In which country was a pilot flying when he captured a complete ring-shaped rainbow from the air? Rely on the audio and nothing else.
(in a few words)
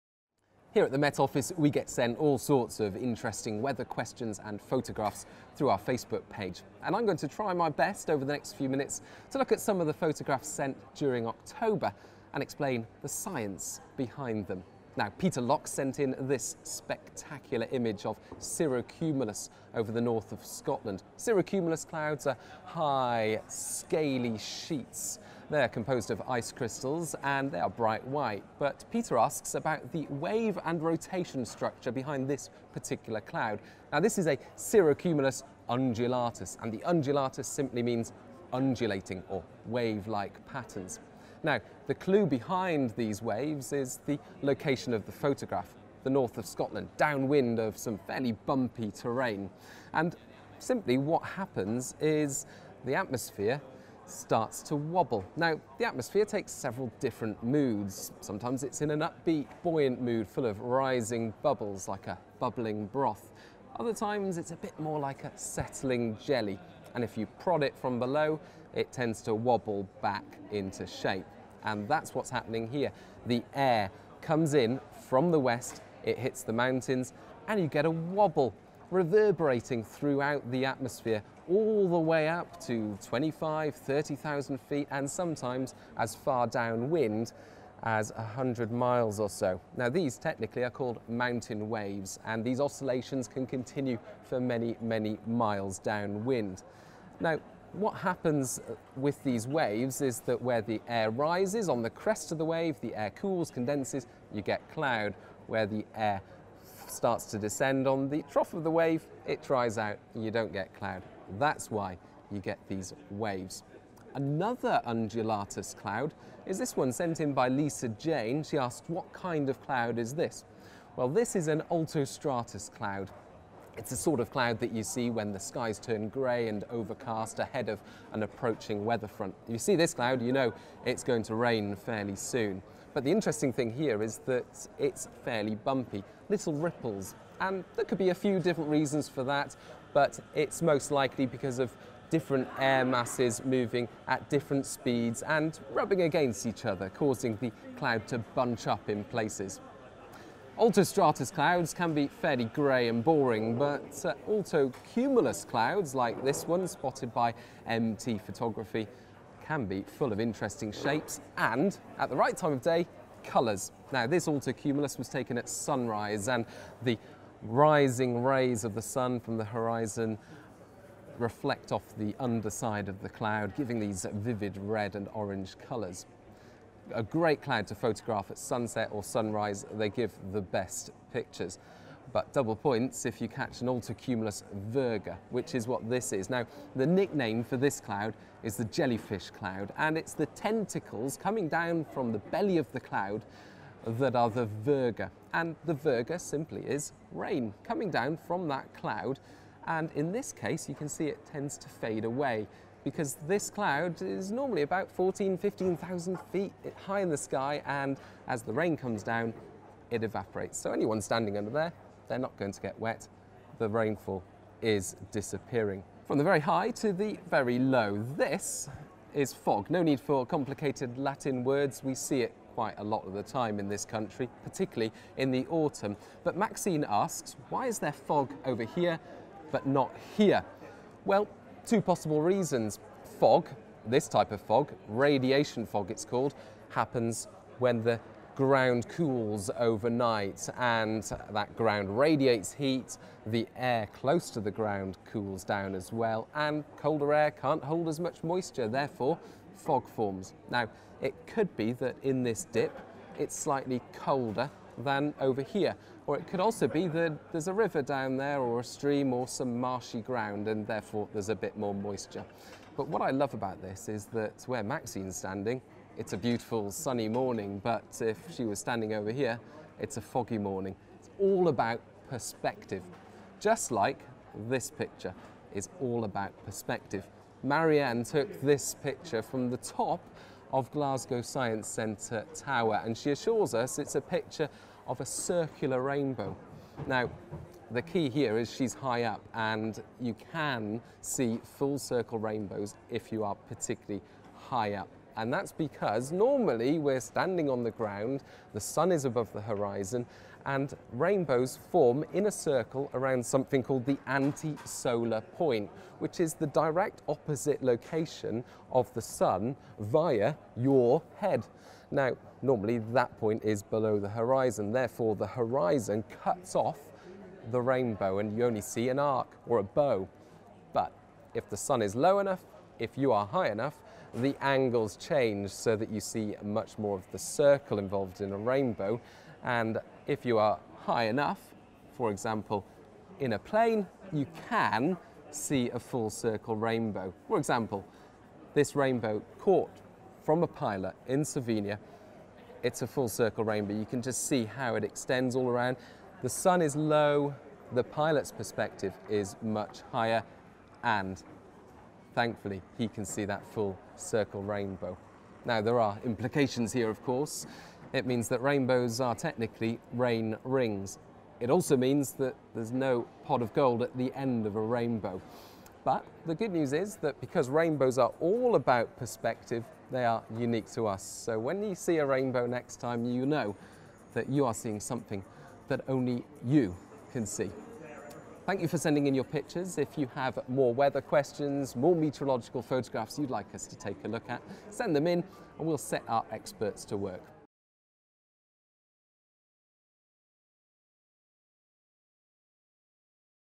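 Slovenia.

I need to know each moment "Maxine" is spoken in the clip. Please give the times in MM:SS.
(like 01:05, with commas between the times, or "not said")
03:46, 04:24.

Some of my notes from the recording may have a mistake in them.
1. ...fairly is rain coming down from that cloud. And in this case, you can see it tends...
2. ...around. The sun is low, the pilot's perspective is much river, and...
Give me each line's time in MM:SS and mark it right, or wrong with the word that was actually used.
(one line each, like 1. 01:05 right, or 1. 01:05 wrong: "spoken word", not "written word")
1. 03:16 wrong: "simply", not "fairly"
2. 05:45 wrong: "higher", not "river".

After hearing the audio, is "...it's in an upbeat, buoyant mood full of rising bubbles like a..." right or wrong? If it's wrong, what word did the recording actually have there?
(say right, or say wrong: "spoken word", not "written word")
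right.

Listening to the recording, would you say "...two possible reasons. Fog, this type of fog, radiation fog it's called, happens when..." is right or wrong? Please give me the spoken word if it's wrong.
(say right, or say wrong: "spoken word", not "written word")
right.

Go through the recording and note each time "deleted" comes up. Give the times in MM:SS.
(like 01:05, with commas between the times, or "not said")
not said.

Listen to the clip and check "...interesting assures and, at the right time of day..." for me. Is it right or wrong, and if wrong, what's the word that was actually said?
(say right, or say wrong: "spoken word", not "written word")
wrong: "shapes", not "assures".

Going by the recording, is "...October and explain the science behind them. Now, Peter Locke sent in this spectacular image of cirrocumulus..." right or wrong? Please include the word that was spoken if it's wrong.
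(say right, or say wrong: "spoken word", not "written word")
right.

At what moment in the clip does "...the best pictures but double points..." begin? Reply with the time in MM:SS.
03:00.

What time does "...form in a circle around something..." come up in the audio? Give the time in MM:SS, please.
05:01.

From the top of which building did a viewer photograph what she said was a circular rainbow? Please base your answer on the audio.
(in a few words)
Glasgow Science Centre Tower.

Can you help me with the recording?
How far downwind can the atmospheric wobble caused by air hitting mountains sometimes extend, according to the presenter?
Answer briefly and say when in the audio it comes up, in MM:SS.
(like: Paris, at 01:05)
100 miles, at 01:28.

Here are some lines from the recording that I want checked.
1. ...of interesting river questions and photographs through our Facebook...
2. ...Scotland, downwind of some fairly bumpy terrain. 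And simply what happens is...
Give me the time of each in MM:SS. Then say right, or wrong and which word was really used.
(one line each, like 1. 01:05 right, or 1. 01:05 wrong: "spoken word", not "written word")
1. 00:02 wrong: "weather", not "river"
2. 00:46 right.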